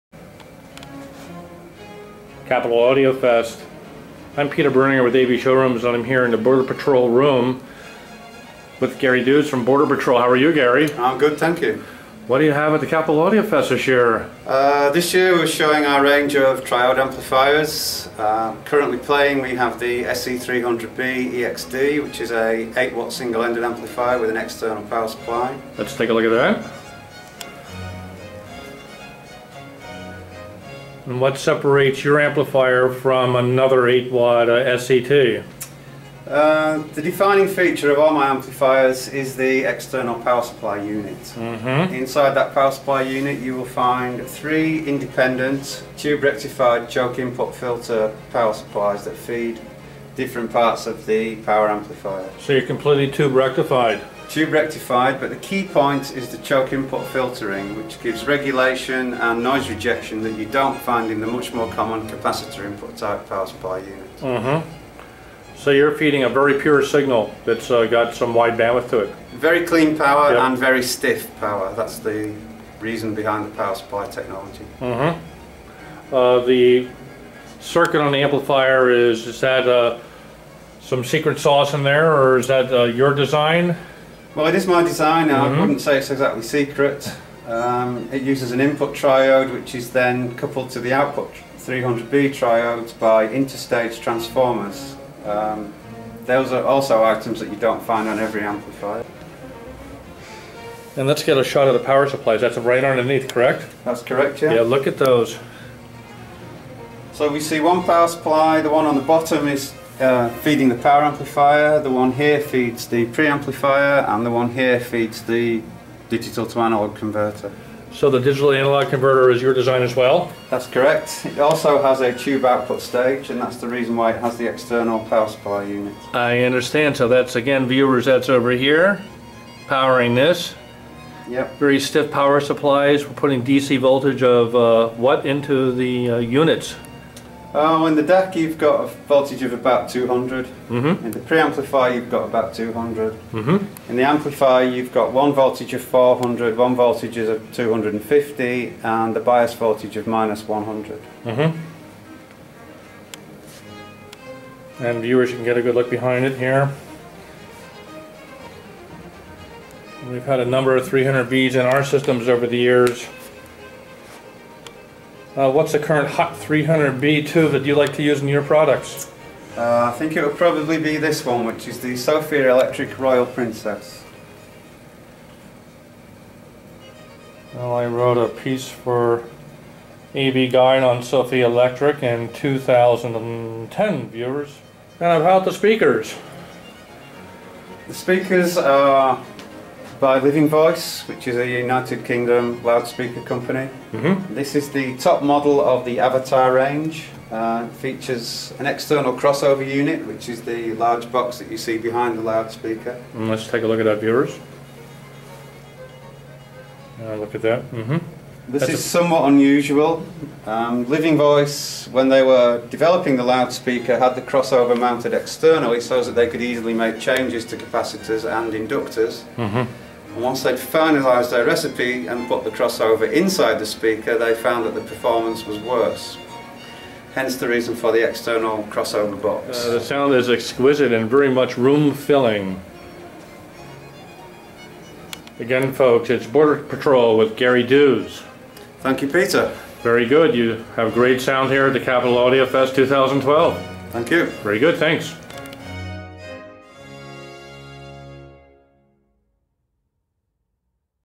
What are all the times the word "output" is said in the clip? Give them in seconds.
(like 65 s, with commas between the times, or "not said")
90 s, 122 s.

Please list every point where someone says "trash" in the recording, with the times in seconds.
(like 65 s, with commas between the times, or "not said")
not said.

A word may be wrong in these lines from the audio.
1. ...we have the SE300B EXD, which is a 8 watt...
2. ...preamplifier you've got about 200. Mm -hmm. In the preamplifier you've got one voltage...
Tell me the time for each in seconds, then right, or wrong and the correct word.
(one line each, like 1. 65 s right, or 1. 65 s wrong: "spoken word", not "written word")
1. 19 s right
2. 141 s wrong: "amplifier", not "preamplifier".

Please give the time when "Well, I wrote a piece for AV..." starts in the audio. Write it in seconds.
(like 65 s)
177 s.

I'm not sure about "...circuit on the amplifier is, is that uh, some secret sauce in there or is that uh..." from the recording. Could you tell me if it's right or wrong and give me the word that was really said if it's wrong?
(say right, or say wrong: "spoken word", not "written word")
right.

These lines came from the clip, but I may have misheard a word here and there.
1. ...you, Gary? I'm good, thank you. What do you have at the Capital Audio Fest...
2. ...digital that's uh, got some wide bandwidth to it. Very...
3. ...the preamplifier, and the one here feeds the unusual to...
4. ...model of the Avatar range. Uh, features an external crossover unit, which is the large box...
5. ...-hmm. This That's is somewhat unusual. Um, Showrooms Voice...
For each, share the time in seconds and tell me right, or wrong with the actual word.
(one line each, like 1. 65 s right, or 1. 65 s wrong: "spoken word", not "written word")
1. 10 s right
2. 66 s wrong: "signal", not "digital"
3. 112 s wrong: "digital", not "unusual"
4. 195 s right
5. 207 s wrong: "Living", not "Showrooms".